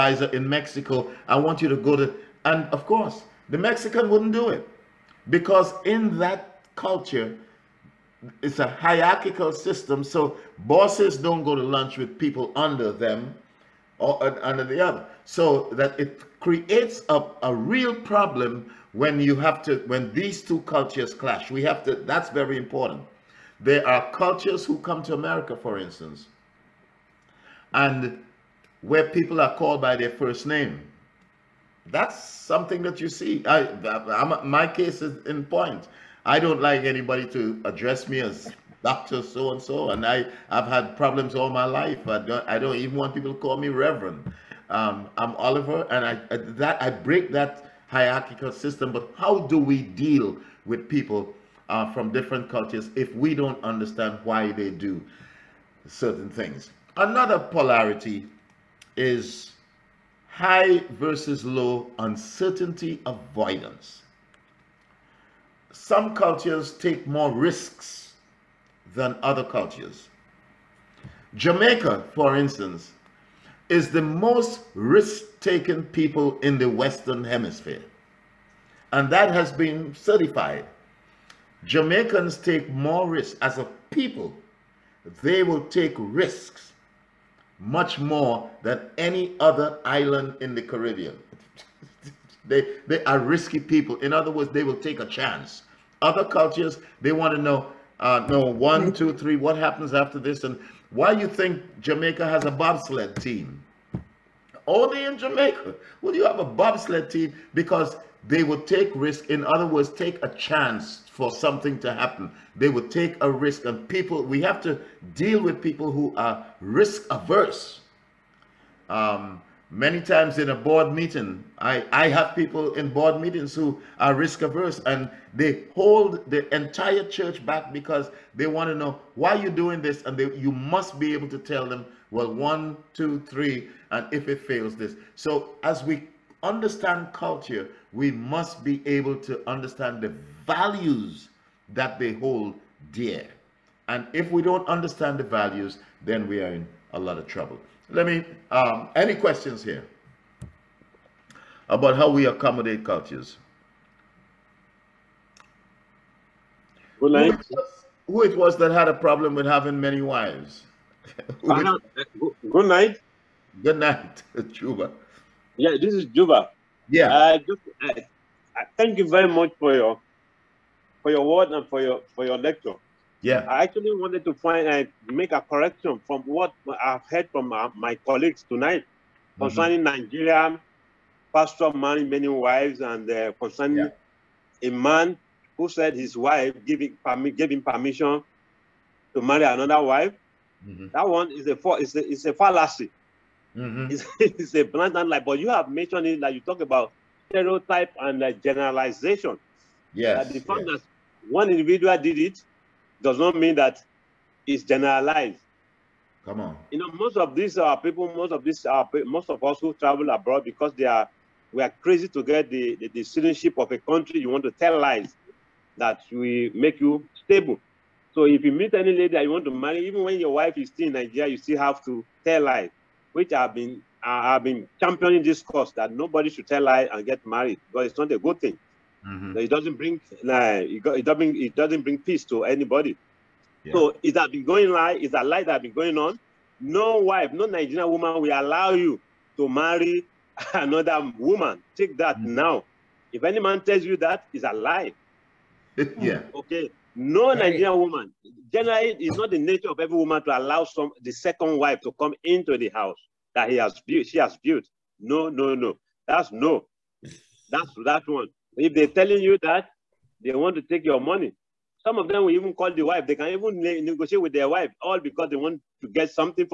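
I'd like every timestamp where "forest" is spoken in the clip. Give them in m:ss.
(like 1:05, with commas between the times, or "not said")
not said.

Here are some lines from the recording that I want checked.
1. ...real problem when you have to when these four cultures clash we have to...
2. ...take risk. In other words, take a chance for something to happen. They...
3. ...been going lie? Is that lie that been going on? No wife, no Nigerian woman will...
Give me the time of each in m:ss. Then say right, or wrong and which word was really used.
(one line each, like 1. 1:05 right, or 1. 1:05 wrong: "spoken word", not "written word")
1. 0:17 wrong: "two", not "four"
2. 1:48 right
3. 3:54 right.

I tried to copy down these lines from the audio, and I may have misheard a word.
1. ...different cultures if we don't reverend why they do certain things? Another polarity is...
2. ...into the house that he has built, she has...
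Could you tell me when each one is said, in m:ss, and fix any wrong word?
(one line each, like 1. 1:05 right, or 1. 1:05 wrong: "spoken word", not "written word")
1. 0:52 wrong: "understand", not "reverend"
2. 4:12 right.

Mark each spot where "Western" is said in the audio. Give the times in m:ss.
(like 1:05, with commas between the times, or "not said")
1:16.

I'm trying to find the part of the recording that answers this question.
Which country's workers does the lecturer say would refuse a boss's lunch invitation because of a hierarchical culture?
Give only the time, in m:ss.
0:00.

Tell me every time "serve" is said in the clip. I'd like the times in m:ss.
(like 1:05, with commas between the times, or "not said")
not said.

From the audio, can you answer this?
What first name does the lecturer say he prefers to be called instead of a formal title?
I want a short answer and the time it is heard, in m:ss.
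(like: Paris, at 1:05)
Oliver, at 0:45.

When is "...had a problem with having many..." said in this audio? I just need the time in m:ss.
2:38.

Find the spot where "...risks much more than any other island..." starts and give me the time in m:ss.
1:25.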